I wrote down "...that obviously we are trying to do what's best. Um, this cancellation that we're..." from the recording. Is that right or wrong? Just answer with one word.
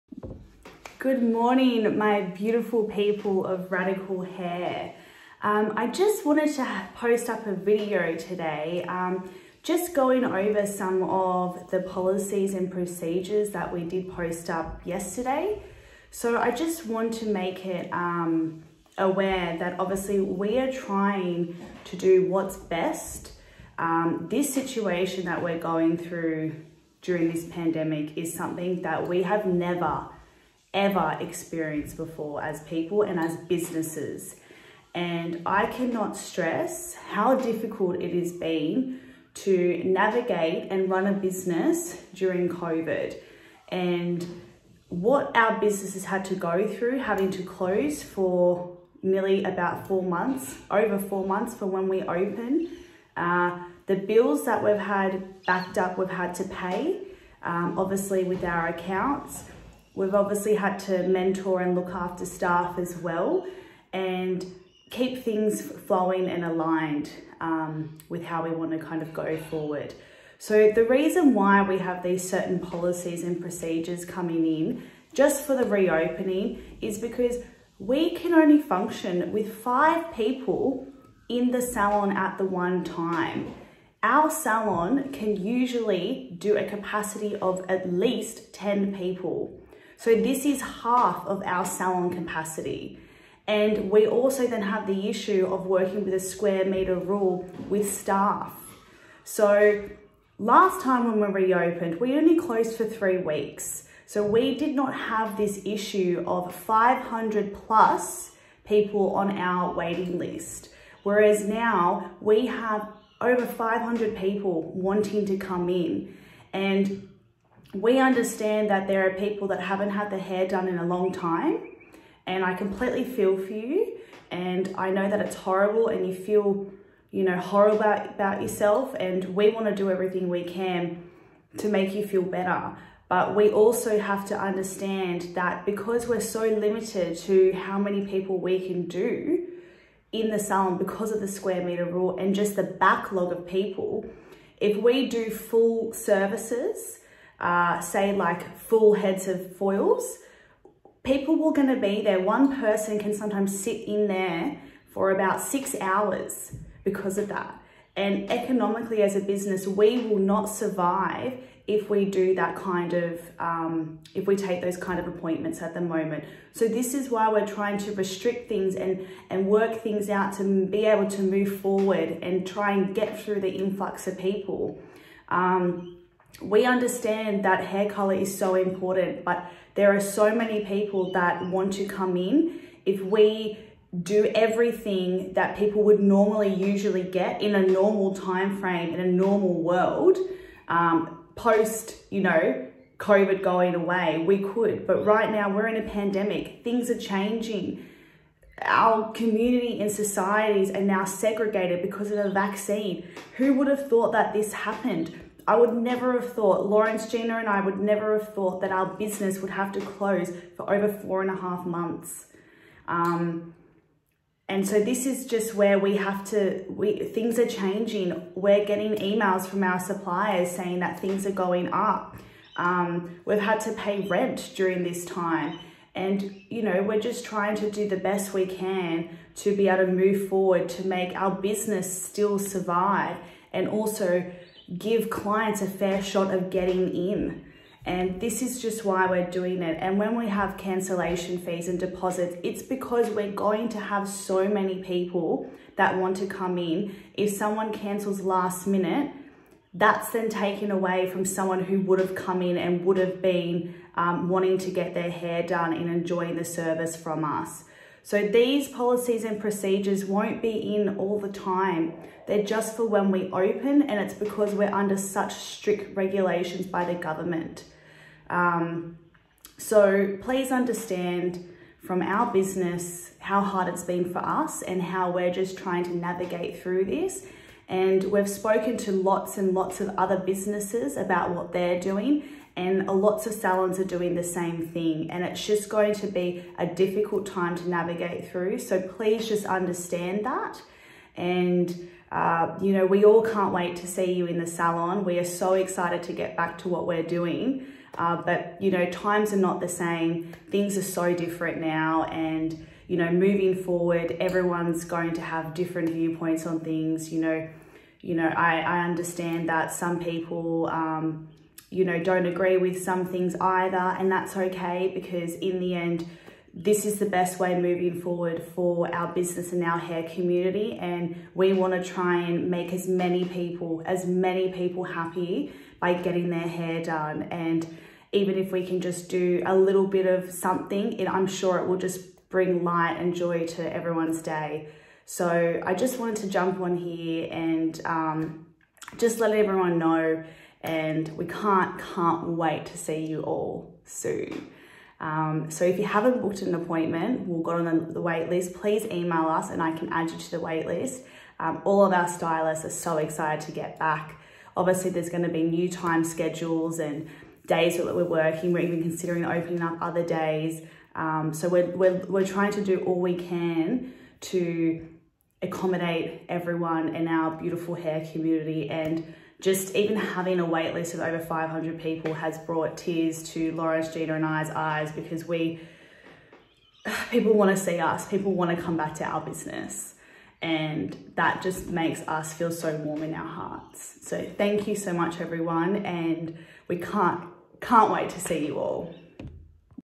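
wrong.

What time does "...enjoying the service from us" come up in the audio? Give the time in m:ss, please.
4:15.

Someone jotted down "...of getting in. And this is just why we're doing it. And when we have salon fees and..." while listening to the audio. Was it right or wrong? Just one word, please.
wrong.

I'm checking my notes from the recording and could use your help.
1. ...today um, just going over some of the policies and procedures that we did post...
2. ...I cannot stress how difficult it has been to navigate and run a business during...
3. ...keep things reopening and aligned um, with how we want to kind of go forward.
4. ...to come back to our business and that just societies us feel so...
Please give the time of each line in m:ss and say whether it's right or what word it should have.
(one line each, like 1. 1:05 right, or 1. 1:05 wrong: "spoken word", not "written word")
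1. 0:08 right
2. 0:35 right
3. 1:04 wrong: "flowing", not "reopening"
4. 6:18 wrong: "makes", not "societies".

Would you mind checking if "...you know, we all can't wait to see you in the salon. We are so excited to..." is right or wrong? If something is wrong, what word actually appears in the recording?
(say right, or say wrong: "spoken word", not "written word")
right.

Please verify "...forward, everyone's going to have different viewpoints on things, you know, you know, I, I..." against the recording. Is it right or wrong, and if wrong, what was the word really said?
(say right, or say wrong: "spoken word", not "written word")
right.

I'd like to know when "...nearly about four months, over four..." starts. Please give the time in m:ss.
0:49.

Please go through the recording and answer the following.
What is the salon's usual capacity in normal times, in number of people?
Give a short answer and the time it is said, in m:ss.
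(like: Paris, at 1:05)
10, at 1:28.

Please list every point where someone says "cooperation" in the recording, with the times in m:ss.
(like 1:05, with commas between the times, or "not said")
not said.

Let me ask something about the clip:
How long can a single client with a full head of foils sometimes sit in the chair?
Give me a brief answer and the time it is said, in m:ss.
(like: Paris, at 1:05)
6 hours, at 2:35.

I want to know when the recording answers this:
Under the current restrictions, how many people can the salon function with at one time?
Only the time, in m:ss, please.
1:19.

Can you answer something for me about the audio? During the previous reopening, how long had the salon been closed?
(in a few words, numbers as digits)
3 weeks.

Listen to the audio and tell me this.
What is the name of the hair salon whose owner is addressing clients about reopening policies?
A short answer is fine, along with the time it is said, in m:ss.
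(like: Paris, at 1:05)
Radical Hair, at 0:03.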